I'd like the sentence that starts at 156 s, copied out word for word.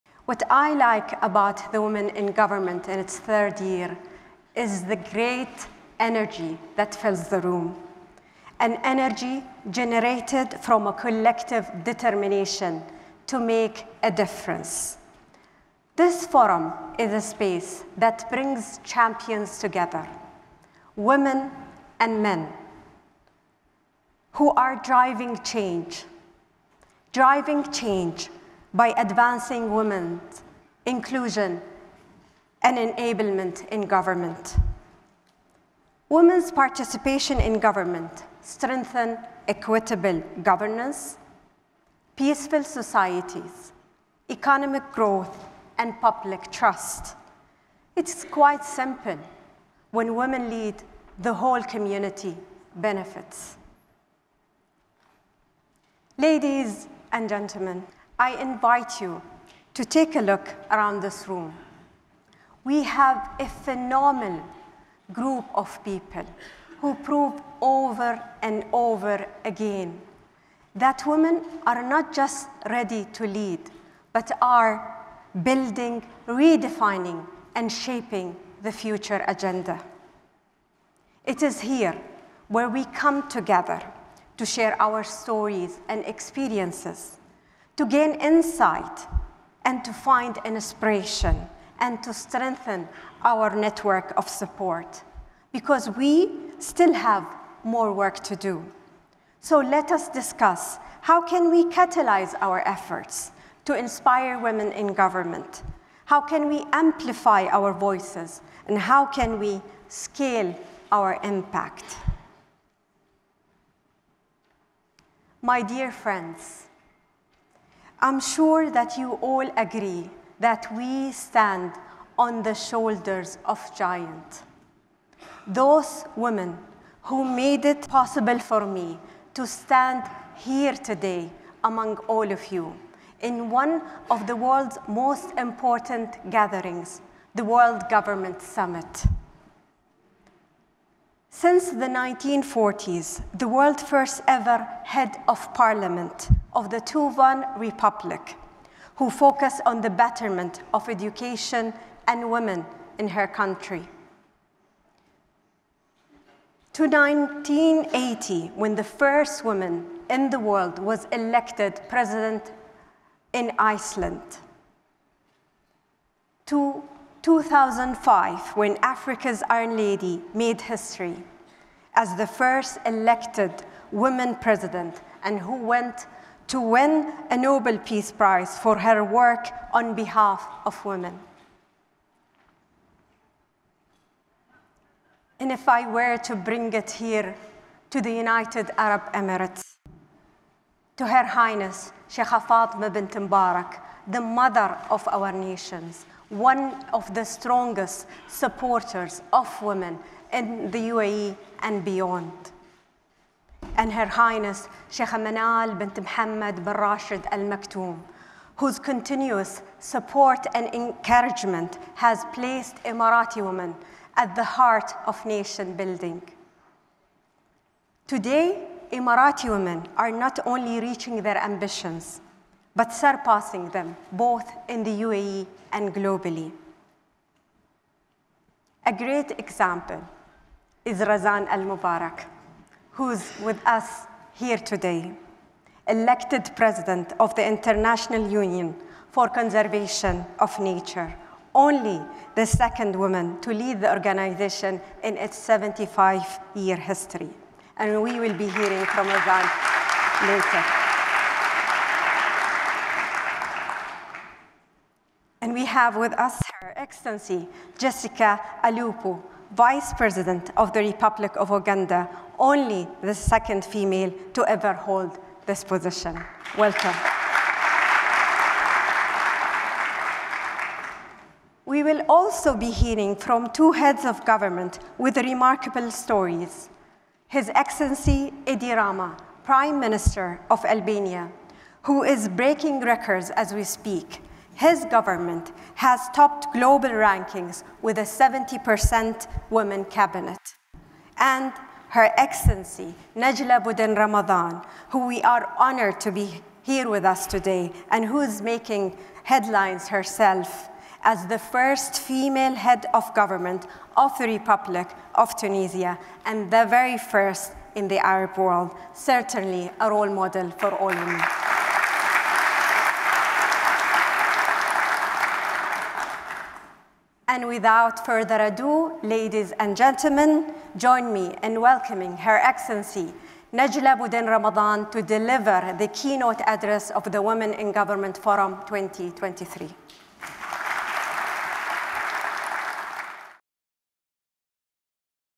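To 1980, when the first woman in the world was elected president in Iceland.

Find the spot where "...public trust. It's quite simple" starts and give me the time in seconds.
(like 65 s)
45 s.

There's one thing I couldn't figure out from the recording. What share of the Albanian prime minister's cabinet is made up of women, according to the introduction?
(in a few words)
70%.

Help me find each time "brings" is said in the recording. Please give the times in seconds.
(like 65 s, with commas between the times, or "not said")
18 s, 186 s.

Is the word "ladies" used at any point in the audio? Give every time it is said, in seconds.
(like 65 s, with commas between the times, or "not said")
56 s, 319 s.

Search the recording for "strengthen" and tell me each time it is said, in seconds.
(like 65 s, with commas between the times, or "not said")
38 s, 92 s.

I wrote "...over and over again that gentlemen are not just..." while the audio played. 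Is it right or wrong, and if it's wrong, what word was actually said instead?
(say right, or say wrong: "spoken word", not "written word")
wrong: "women", not "gentlemen".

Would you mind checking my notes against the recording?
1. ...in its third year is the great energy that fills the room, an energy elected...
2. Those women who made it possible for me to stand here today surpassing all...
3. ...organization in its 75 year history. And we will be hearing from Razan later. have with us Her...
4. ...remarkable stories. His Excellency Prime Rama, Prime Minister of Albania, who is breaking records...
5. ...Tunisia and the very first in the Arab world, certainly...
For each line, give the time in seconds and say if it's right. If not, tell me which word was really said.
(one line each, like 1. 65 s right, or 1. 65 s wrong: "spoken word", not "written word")
1. 2 s wrong: "generated", not "elected"
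2. 125 s wrong: "among", not "surpassing"
3. 243 s right
4. 275 s wrong: "Edi", not "Prime"
5. 305 s right.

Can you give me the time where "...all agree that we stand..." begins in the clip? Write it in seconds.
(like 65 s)
119 s.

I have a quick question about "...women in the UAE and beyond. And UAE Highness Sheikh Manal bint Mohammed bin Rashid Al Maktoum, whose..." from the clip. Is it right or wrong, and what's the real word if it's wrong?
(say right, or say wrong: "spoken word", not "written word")
wrong: "Her", not "UAE".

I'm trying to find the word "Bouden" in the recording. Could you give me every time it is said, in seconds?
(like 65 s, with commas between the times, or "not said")
293 s, 323 s.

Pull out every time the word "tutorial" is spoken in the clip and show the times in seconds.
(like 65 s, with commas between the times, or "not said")
not said.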